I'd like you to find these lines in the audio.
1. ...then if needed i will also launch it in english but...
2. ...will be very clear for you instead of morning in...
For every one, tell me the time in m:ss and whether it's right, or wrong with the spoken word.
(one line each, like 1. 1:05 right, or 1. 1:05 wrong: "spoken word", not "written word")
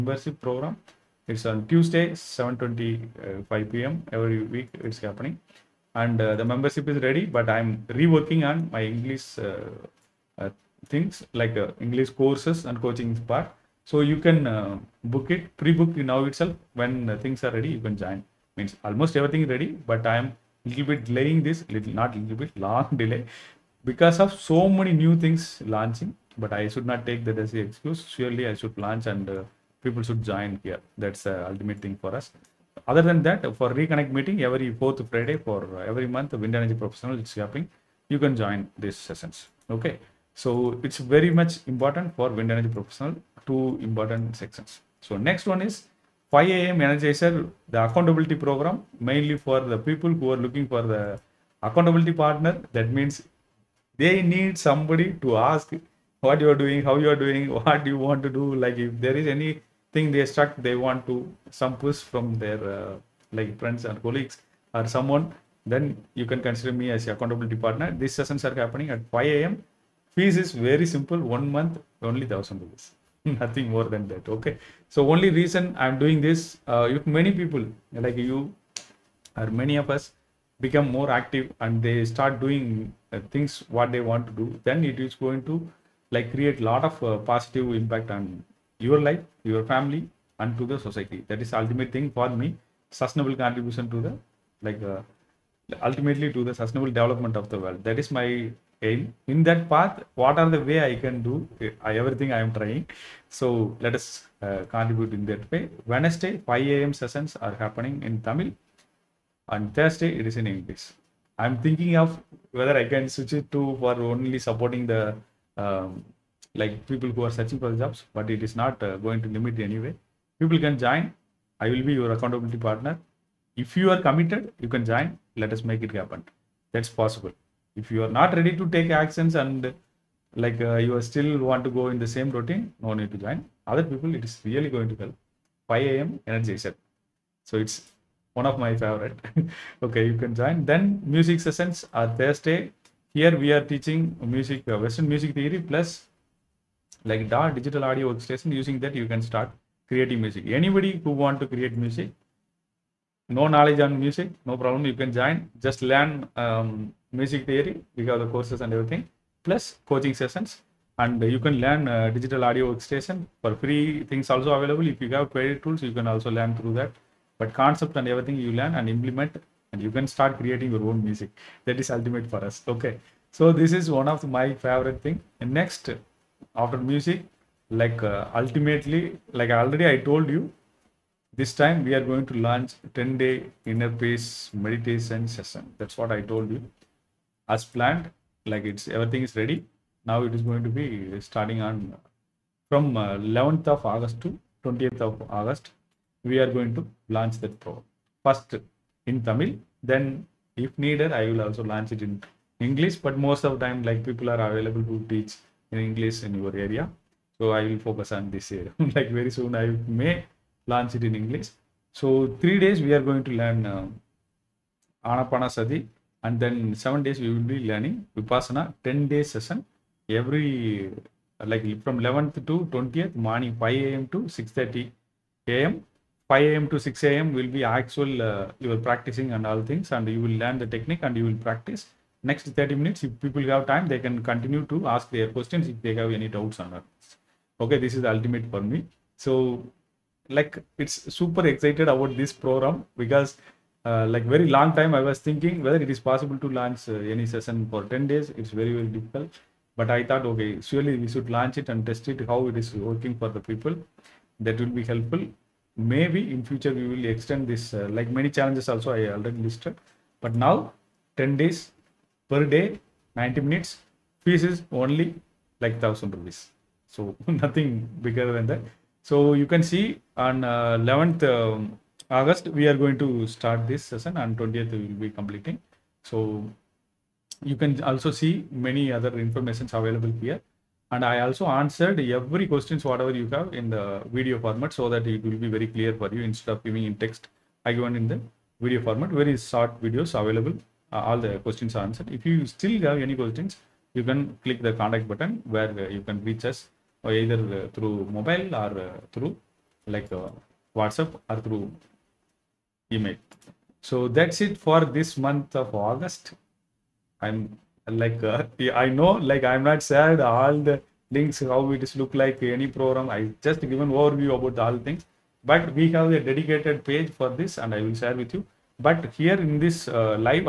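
1. 3:19 right
2. 4:45 wrong: "giving", not "morning".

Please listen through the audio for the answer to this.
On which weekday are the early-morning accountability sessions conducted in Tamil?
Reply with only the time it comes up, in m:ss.
1:45.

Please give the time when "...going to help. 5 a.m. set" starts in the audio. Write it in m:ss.
2:14.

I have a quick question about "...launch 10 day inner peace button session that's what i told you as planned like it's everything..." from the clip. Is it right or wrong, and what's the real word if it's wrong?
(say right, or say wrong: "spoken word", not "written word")
wrong: "meditation", not "button".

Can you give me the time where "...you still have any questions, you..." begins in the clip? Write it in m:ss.
4:52.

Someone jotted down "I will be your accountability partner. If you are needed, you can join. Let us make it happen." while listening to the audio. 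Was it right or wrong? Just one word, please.
wrong.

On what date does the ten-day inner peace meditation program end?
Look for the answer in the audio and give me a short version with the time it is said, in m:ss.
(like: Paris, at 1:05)
20 August, at 3:14.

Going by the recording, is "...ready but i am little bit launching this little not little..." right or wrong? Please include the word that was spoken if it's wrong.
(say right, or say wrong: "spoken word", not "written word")
wrong: "delaying", not "launching".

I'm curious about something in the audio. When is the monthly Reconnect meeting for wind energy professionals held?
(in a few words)
Every fourth Friday.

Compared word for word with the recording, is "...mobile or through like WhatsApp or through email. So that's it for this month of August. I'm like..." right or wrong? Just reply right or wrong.
right.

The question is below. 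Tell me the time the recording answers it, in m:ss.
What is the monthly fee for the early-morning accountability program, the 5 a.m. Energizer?
1:12.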